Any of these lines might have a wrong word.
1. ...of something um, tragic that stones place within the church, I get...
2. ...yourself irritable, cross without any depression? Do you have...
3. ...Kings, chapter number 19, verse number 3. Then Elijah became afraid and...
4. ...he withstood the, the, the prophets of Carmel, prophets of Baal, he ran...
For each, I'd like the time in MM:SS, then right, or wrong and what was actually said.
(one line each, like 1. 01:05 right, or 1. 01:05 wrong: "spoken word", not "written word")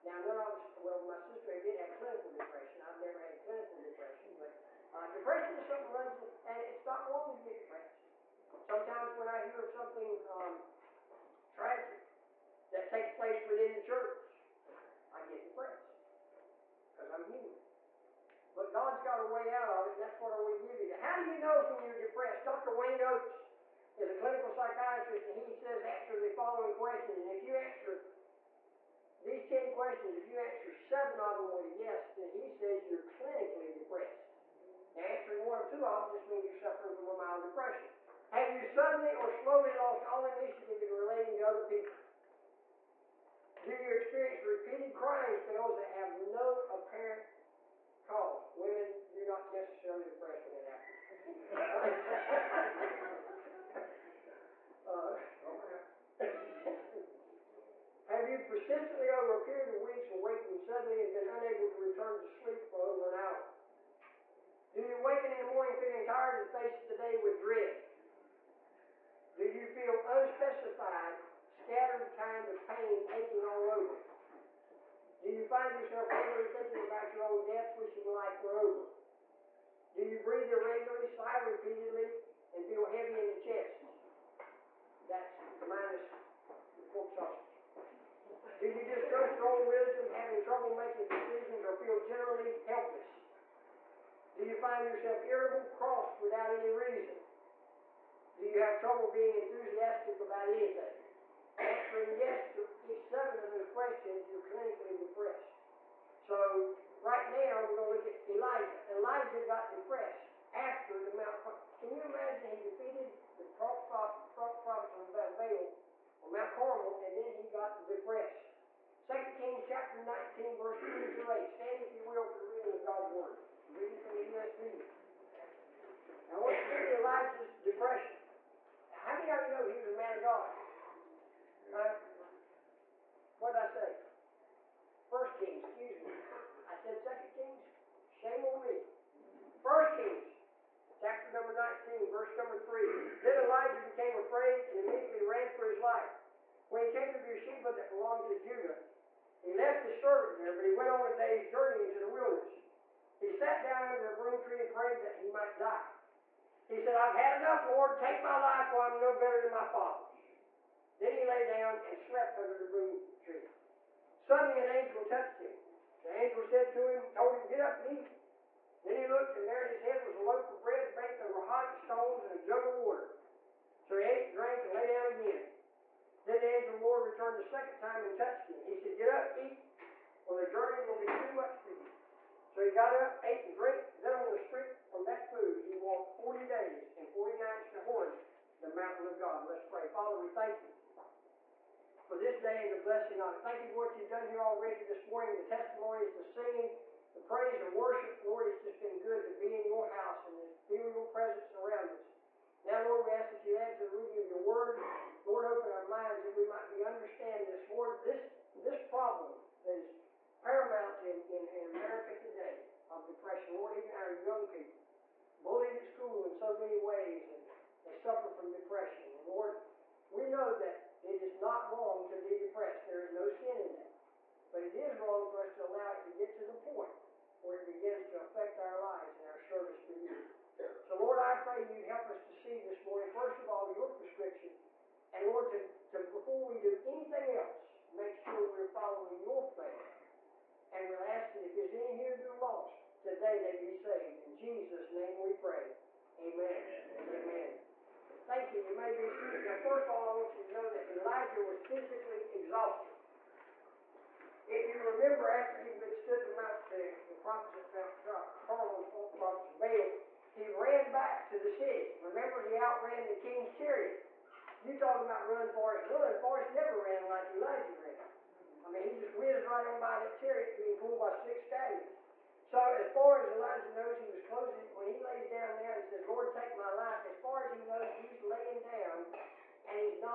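1. 00:09 wrong: "takes", not "stones"
2. 01:34 wrong: "reason", not "depression"
3. 02:19 right
4. 04:15 right.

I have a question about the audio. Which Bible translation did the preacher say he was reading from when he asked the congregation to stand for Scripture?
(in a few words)
ESV.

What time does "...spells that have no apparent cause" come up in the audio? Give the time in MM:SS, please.
00:45.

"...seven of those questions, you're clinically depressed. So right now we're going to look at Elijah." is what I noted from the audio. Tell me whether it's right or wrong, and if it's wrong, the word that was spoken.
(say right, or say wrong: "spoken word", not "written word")
right.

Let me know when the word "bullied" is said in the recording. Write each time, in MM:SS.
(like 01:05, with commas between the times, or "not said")
03:35.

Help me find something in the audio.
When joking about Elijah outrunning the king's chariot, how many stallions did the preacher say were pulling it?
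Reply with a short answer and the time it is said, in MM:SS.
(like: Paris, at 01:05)
6, at 04:31.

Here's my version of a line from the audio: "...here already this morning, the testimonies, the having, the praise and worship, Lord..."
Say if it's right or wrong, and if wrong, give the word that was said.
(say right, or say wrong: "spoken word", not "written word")
wrong: "singing", not "having".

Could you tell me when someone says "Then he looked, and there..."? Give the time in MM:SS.
02:48.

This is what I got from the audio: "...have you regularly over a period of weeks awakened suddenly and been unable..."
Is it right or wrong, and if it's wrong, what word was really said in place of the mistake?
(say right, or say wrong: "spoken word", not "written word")
wrong: "persistently", not "regularly".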